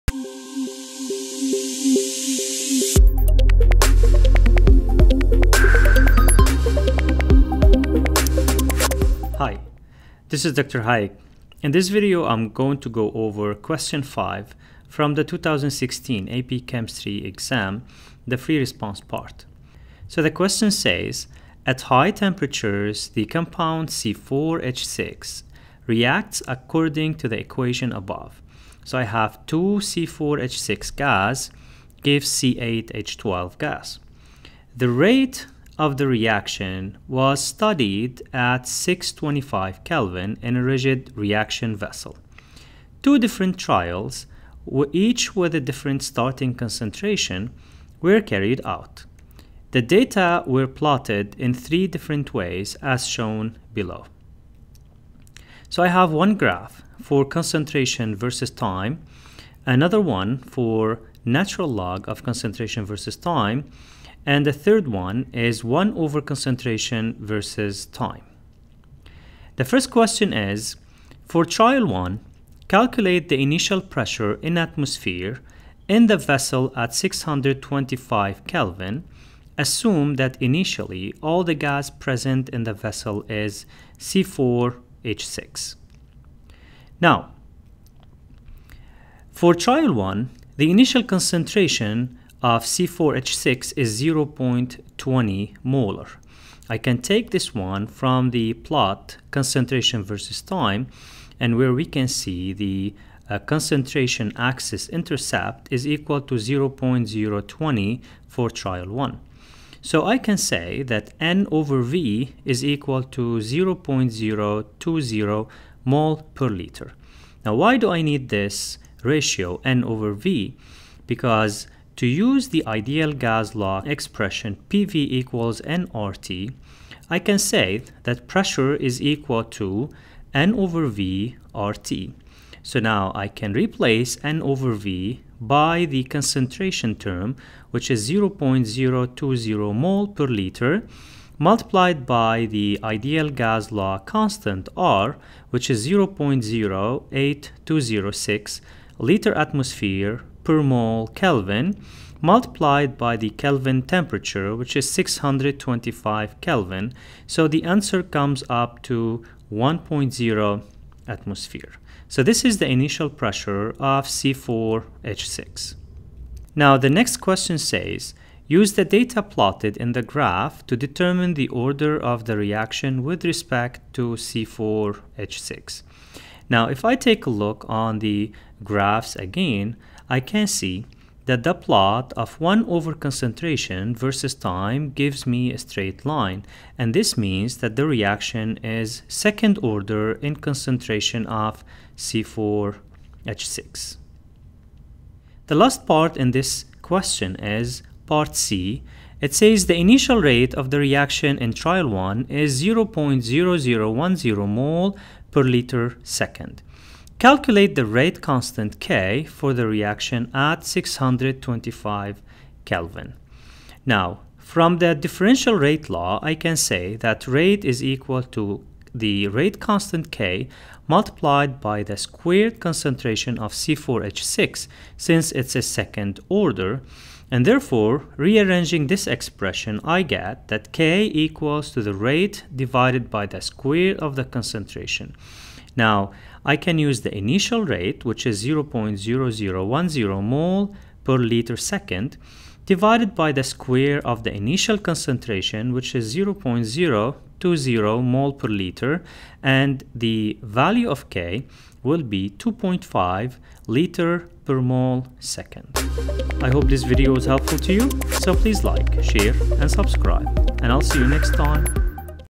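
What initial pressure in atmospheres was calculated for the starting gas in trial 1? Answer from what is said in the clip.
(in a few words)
1.0 atmosphere.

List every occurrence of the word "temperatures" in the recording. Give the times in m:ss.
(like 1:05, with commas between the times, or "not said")
0:22, 2:33.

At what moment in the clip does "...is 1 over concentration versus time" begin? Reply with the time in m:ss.
1:05.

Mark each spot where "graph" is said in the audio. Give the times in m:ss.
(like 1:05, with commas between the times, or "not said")
0:56, 2:50, 2:58.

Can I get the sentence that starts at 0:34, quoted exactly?
The rate of the reaction was studied at 625 Kelvin in a rigid reaction vessel.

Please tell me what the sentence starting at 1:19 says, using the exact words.
Assume that initially all the gas present in the vessel is C4H6.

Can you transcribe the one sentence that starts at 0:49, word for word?
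The data were plotted in three different ways as shown below.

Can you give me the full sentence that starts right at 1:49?
So I can say that N over V is equal to 0.020 mole per liter.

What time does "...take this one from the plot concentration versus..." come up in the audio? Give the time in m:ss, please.
1:36.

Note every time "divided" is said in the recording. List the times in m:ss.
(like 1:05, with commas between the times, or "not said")
3:52, 4:02.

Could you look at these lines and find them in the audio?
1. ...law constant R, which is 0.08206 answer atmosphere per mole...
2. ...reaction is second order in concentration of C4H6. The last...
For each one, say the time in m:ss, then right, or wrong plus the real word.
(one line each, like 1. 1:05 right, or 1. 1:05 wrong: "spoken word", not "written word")
1. 2:23 wrong: "liter", not "answer"
2. 3:07 right.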